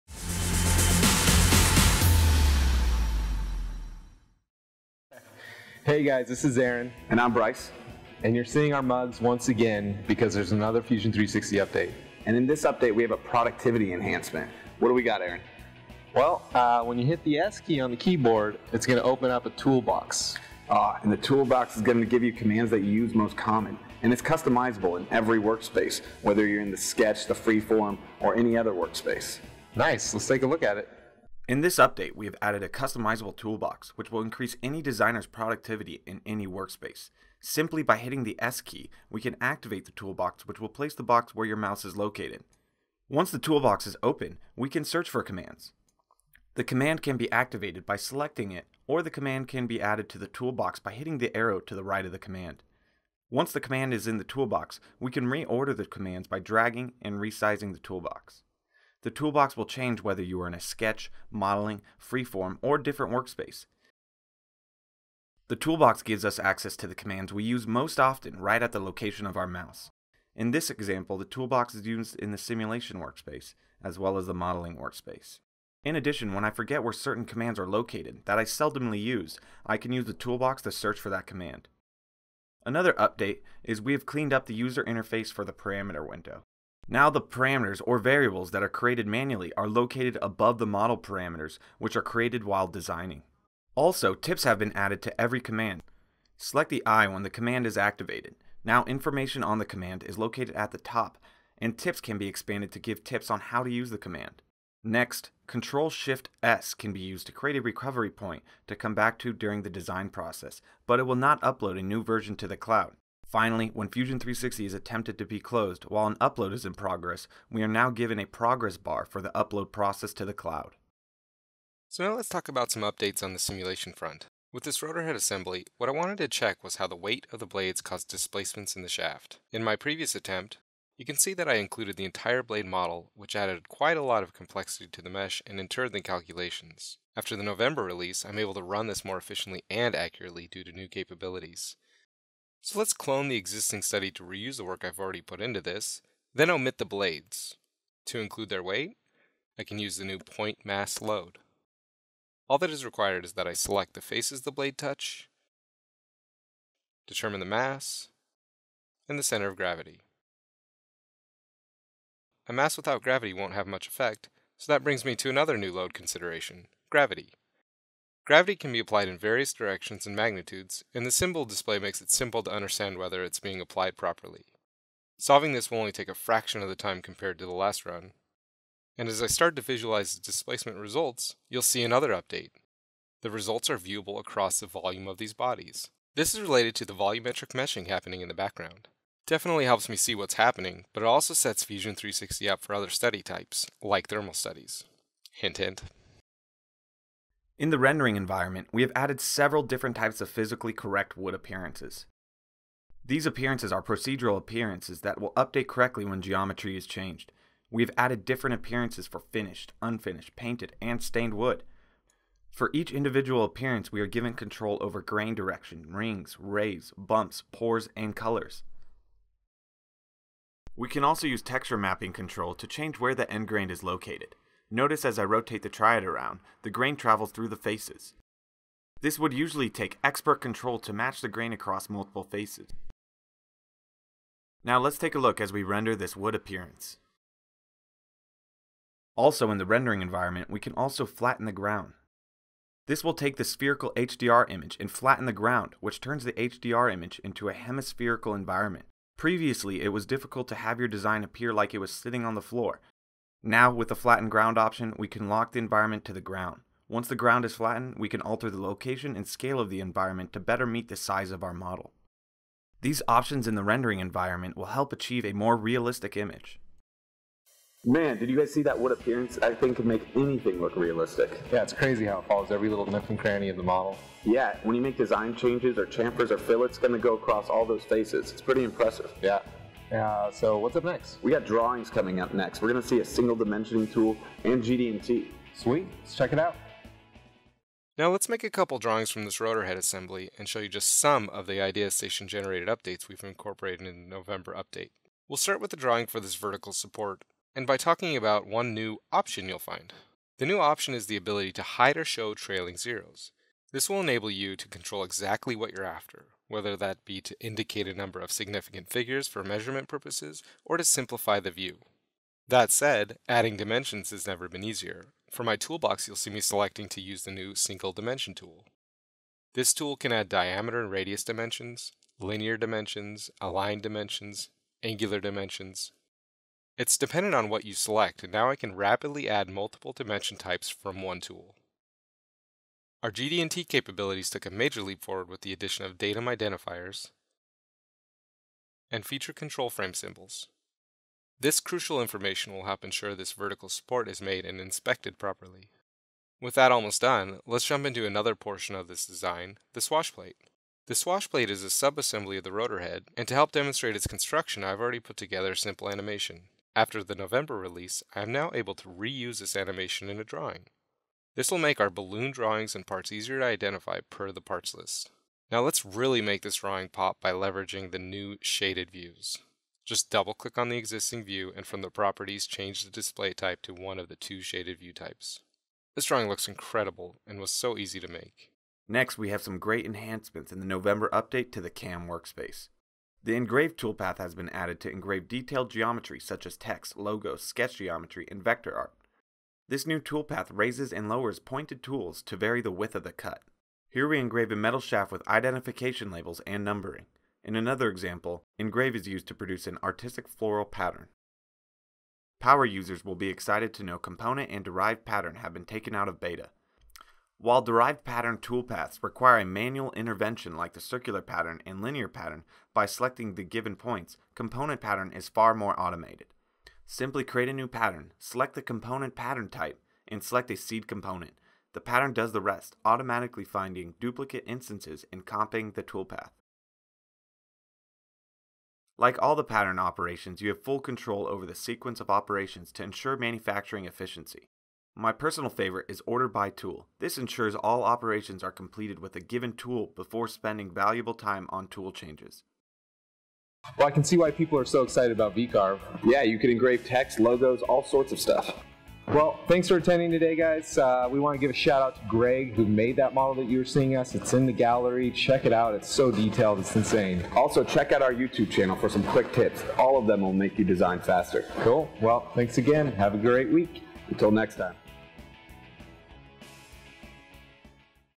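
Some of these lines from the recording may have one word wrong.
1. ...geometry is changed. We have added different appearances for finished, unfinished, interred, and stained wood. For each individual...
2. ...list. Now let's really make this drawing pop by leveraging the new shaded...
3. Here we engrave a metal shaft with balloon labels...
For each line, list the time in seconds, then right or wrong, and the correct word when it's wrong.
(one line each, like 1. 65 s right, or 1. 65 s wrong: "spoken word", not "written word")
1. 206 s wrong: "painted", not "interred"
2. 364 s right
3. 393 s wrong: "identification", not "balloon".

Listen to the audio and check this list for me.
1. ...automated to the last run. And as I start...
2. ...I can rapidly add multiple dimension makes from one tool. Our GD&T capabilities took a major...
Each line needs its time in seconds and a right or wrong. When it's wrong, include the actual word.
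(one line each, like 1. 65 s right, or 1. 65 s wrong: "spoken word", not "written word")
1. 177 s wrong: "compared", not "automated"
2. 328 s wrong: "types", not "makes".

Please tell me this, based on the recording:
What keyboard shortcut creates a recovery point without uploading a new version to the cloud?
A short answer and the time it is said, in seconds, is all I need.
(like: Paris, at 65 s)
Control-Shift-S, at 105 s.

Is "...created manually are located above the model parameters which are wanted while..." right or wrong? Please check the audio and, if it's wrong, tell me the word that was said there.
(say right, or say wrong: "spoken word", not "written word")
wrong: "created", not "wanted".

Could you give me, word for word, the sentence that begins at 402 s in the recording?
Power users will be excited to know component and derived pattern have been taken out of beta.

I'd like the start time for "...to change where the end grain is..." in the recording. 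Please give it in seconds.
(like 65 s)
222 s.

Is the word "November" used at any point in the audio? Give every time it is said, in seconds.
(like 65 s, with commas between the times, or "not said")
137 s, 294 s, 357 s, 380 s.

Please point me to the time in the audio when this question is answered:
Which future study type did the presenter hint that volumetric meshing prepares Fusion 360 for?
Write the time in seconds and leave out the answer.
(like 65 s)
194 s.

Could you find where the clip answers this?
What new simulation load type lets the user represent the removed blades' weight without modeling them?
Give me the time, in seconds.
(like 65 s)
150 s.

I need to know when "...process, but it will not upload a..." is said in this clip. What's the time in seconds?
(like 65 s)
110 s.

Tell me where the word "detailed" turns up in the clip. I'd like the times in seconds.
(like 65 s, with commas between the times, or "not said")
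385 s, 456 s.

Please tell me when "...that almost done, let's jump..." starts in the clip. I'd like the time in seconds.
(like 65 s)
346 s.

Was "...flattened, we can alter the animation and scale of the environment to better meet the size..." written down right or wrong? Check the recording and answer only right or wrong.
wrong.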